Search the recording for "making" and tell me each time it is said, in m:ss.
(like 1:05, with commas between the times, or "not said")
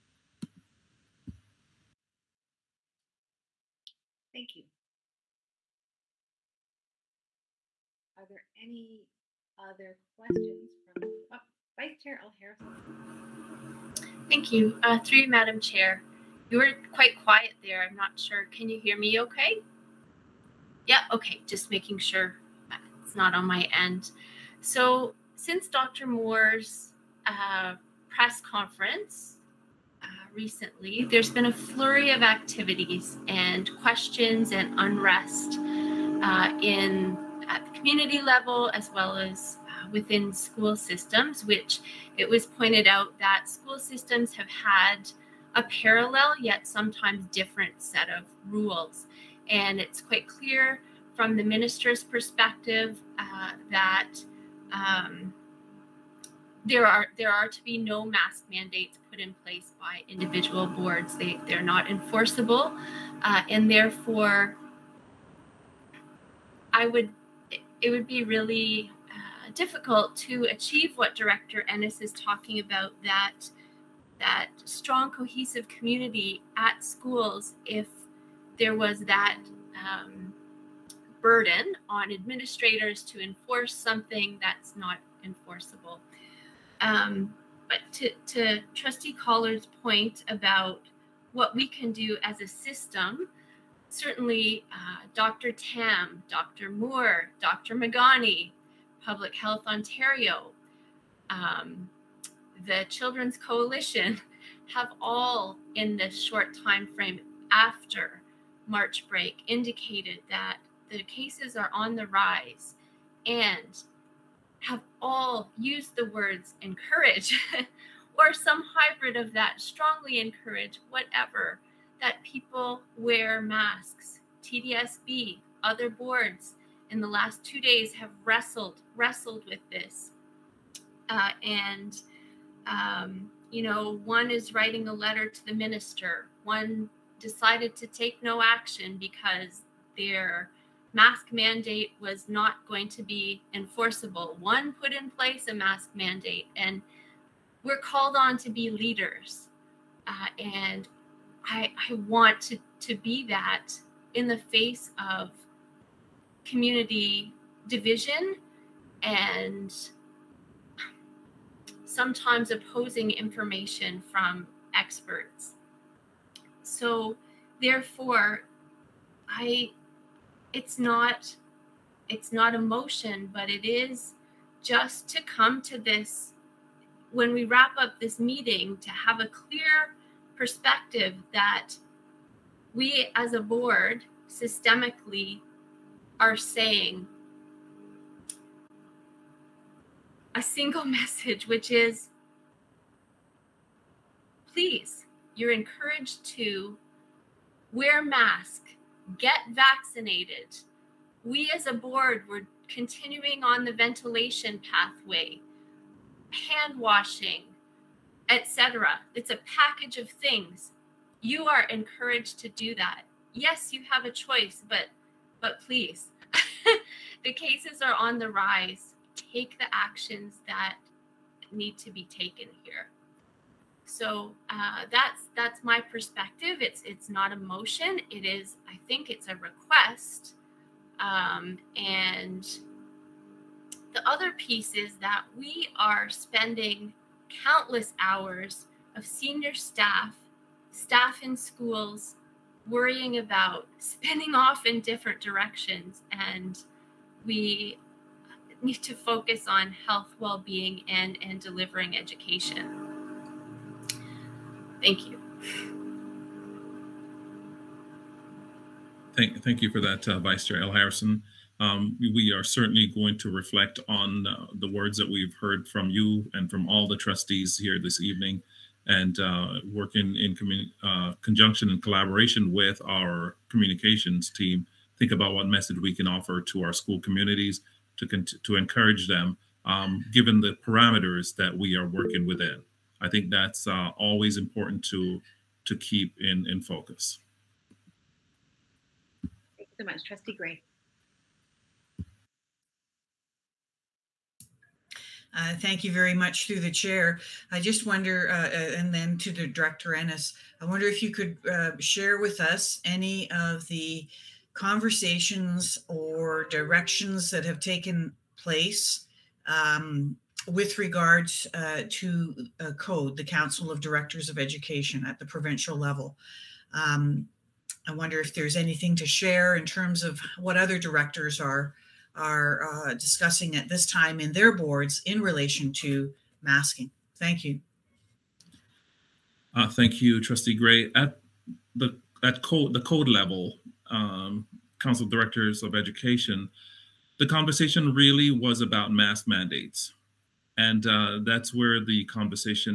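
0:21.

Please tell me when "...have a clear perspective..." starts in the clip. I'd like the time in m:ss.
2:58.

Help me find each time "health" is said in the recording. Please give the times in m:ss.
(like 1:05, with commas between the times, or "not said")
1:39, 4:09.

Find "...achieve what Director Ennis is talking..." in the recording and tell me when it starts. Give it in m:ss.
1:10.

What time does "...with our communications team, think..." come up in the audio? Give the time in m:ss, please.
4:32.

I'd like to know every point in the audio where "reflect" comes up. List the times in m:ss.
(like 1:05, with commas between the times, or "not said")
4:23.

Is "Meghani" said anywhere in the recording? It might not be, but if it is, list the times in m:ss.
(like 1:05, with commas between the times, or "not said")
1:37.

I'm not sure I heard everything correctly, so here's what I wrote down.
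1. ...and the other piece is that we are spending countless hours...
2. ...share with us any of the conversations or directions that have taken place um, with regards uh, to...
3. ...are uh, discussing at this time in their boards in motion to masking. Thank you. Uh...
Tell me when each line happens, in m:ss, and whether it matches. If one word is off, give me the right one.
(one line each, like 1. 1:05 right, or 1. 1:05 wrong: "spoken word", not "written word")
1. 3:51 right
2. 5:01 right
3. 5:22 wrong: "relation", not "motion".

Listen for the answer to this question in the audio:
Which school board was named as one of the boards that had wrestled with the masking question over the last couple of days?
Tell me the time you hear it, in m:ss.
2:04.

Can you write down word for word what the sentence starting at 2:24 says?
One put in place a mask mandate, and we're called on to be leaders.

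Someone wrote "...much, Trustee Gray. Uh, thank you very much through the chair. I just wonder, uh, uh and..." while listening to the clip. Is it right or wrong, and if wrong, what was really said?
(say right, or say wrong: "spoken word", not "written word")
right.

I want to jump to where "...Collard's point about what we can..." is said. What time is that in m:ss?
1:29.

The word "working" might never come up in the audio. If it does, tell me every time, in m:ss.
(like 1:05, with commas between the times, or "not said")
4:29, 4:41.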